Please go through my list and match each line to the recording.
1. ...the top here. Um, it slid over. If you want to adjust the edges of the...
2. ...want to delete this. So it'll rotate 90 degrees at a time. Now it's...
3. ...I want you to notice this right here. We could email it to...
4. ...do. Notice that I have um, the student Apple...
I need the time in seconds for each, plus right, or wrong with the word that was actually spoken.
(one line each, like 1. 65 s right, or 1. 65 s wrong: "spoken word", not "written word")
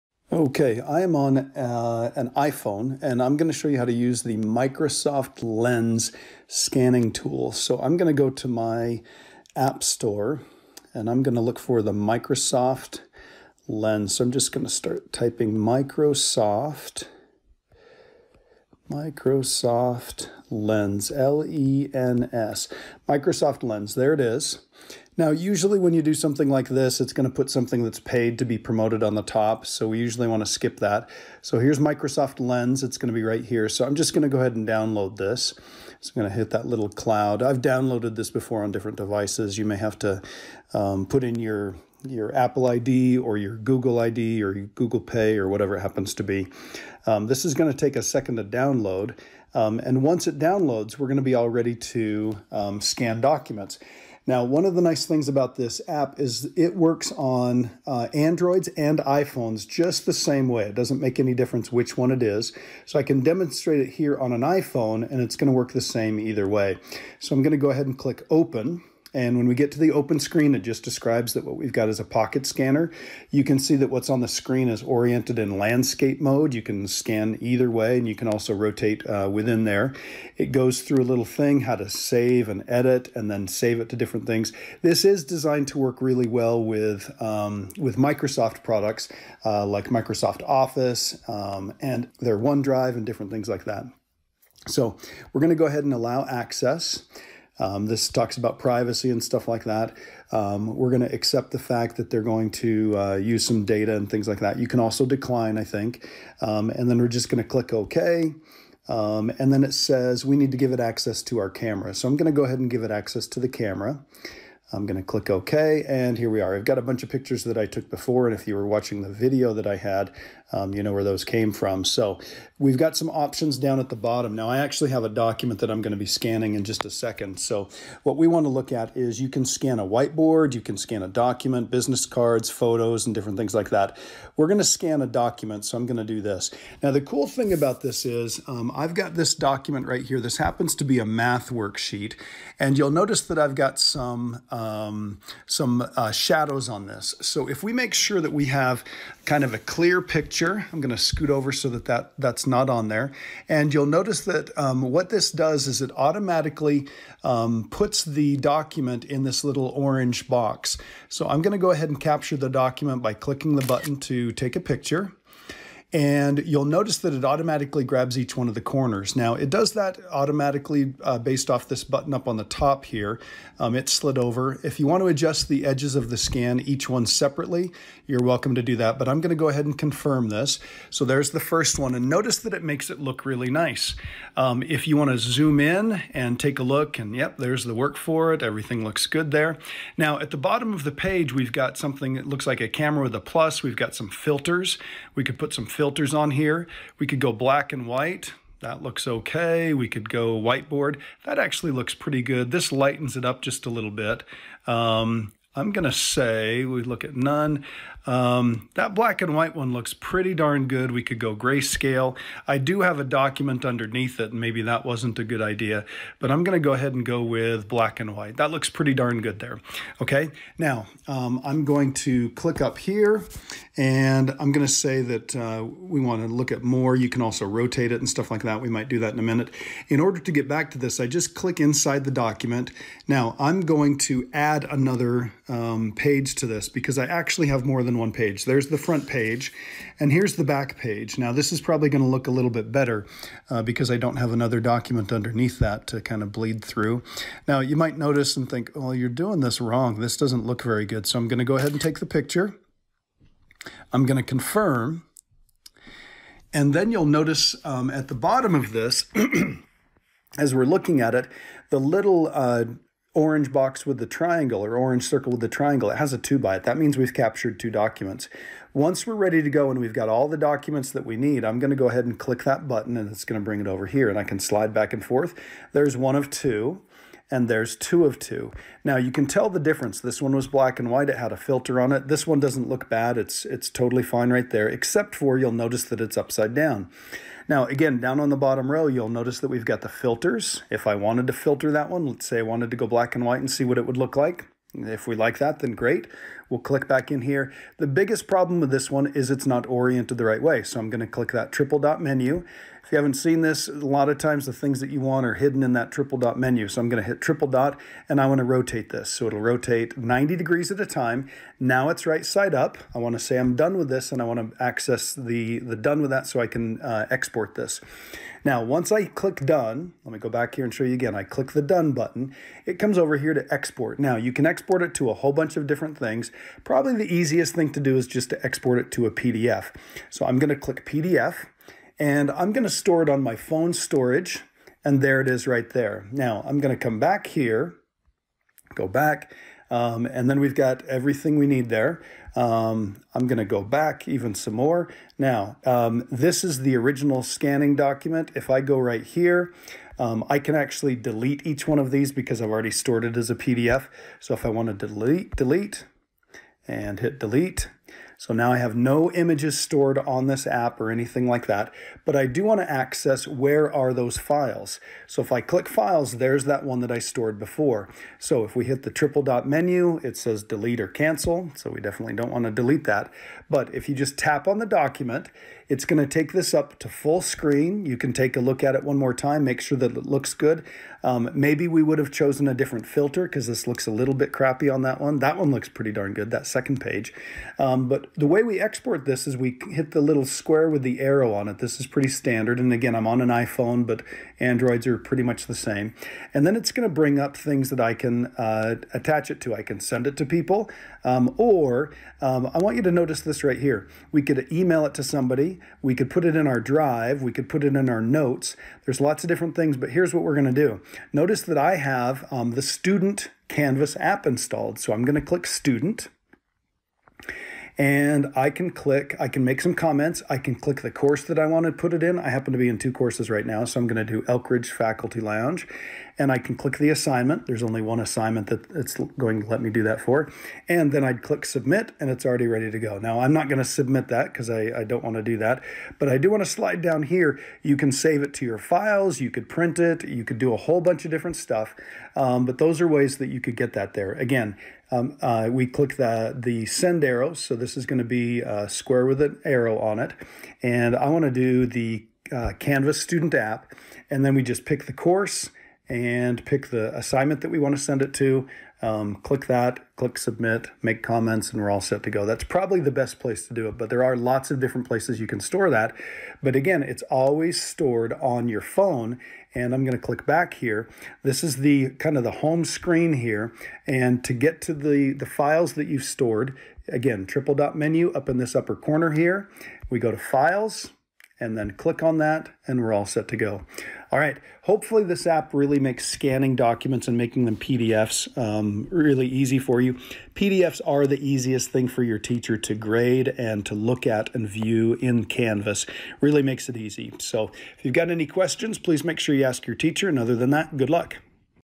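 1. 172 s right
2. 308 s wrong: "rotate", not "delete"
3. 402 s right
4. 410 s wrong: "Canvas", not "Apple".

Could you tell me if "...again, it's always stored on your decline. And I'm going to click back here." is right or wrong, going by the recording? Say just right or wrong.
wrong.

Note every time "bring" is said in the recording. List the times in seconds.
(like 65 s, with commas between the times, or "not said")
273 s, 396 s.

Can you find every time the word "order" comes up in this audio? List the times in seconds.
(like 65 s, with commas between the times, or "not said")
229 s.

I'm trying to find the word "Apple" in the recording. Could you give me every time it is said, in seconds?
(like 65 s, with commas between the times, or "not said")
42 s.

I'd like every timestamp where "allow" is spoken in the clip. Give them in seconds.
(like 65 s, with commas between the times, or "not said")
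95 s.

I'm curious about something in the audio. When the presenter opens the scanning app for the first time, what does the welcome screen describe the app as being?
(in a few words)
a pocket scanner.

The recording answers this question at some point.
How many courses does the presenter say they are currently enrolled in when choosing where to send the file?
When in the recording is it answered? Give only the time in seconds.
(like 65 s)
422 s.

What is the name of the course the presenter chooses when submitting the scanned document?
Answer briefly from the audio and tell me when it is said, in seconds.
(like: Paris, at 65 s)
Elkridge Faculty Lounge, at 424 s.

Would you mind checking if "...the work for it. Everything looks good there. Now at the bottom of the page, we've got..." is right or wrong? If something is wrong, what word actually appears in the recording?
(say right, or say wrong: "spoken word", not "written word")
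right.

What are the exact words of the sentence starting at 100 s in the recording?
Um, we're going to accept the fact that they're going to uh, use some data and things like that.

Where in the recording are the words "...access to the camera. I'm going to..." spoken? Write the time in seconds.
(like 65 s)
112 s.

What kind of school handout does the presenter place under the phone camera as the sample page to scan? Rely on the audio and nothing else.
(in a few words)
a math worksheet.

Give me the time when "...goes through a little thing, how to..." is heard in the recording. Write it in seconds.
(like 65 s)
80 s.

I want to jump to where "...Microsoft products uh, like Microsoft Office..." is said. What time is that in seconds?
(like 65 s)
87 s.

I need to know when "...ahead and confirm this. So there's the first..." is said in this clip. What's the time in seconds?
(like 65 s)
179 s.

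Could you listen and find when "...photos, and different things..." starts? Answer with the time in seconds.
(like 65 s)
132 s.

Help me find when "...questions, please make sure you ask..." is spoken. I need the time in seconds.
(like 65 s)
498 s.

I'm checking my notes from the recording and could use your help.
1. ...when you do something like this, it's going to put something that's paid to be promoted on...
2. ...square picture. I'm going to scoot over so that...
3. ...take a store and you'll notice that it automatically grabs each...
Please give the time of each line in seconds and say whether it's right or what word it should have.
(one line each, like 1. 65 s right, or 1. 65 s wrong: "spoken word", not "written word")
1. 25 s right
2. 150 s wrong: "picture", not "square"
3. 164 s wrong: "picture", not "store".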